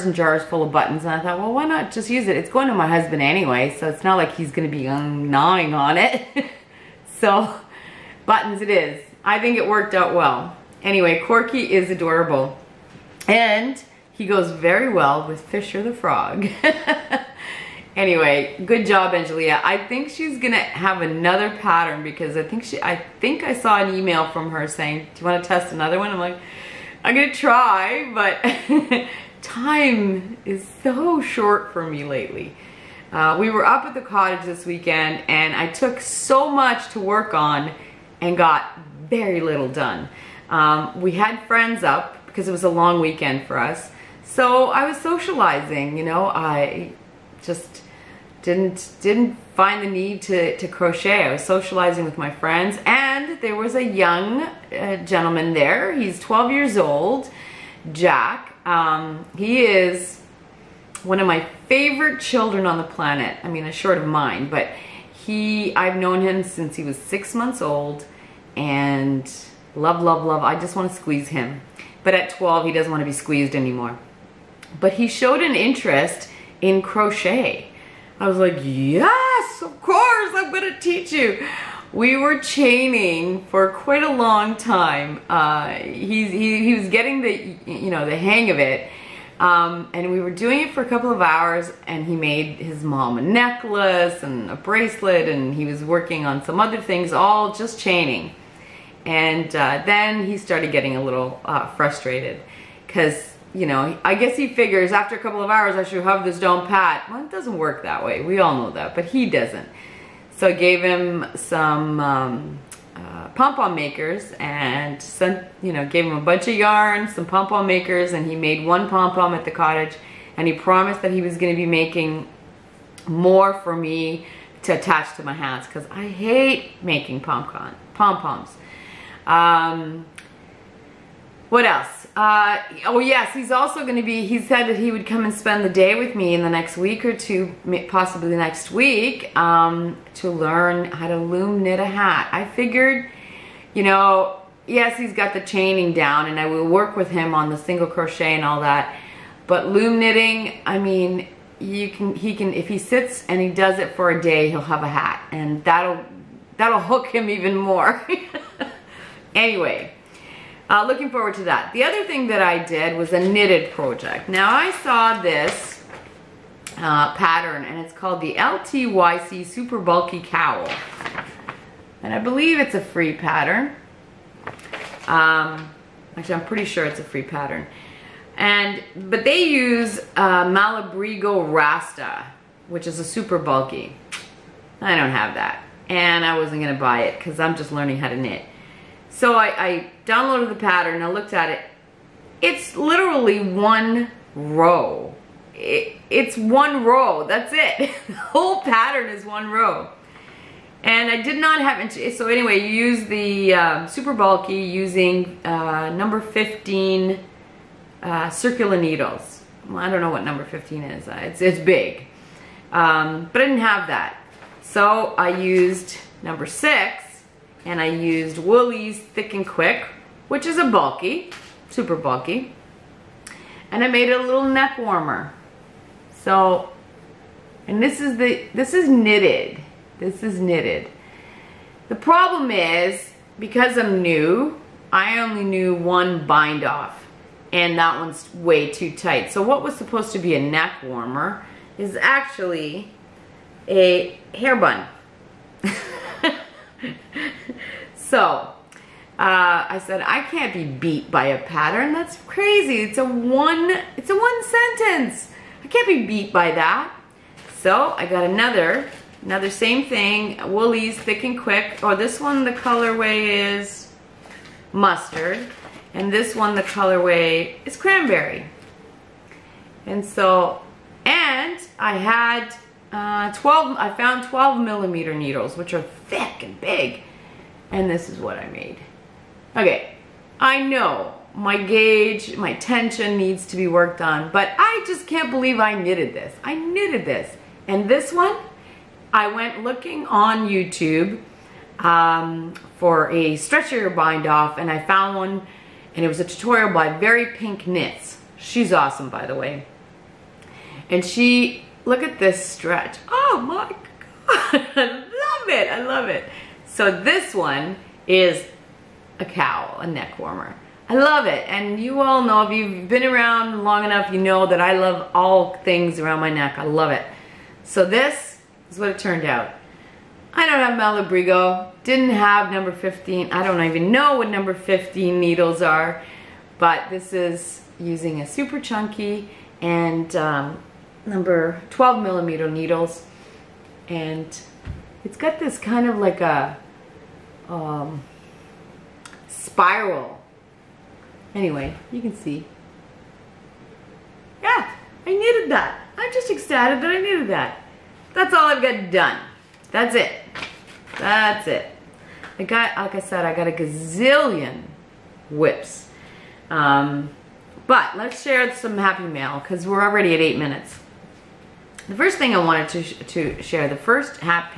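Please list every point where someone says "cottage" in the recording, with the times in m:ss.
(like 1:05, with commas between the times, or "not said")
0:34, 1:59.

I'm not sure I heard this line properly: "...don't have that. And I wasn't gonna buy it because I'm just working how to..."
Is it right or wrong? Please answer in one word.
wrong.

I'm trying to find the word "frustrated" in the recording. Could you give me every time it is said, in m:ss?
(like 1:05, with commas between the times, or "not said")
1:41.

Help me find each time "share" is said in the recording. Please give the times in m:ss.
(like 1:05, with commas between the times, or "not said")
5:58, 6:03.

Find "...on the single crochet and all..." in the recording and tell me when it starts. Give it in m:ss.
2:27.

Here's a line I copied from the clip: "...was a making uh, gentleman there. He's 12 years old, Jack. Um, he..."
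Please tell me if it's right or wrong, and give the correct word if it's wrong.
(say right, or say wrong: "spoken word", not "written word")
wrong: "young", not "making".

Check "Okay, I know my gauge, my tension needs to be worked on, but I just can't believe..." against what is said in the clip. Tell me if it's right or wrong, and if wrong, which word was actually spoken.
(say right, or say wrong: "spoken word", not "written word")
right.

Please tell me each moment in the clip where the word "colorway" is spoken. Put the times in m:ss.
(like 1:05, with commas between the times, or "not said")
4:22, 4:26.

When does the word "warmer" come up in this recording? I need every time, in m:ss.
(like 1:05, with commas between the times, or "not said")
3:44, 4:00, 5:10.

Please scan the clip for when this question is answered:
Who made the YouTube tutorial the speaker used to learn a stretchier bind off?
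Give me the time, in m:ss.
4:56.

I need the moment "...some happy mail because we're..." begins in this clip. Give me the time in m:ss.
5:58.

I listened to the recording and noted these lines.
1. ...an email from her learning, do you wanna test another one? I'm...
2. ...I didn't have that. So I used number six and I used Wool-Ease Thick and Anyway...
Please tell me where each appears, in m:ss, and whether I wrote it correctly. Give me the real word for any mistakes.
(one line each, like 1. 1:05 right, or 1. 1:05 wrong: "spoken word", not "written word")
1. 0:23 wrong: "saying", not "learning"
2. 3:33 wrong: "Quick", not "Anyway".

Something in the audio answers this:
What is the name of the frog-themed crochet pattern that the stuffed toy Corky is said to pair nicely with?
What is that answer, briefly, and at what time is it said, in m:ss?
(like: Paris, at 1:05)
Fisher the Frog, at 0:15.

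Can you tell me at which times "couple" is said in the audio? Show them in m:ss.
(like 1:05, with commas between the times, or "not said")
1:30, 1:45.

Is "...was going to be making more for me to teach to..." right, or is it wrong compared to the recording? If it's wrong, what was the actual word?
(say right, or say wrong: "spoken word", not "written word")
wrong: "attach", not "teach".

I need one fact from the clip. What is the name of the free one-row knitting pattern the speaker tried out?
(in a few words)
LTYC Super Bulky Cowl.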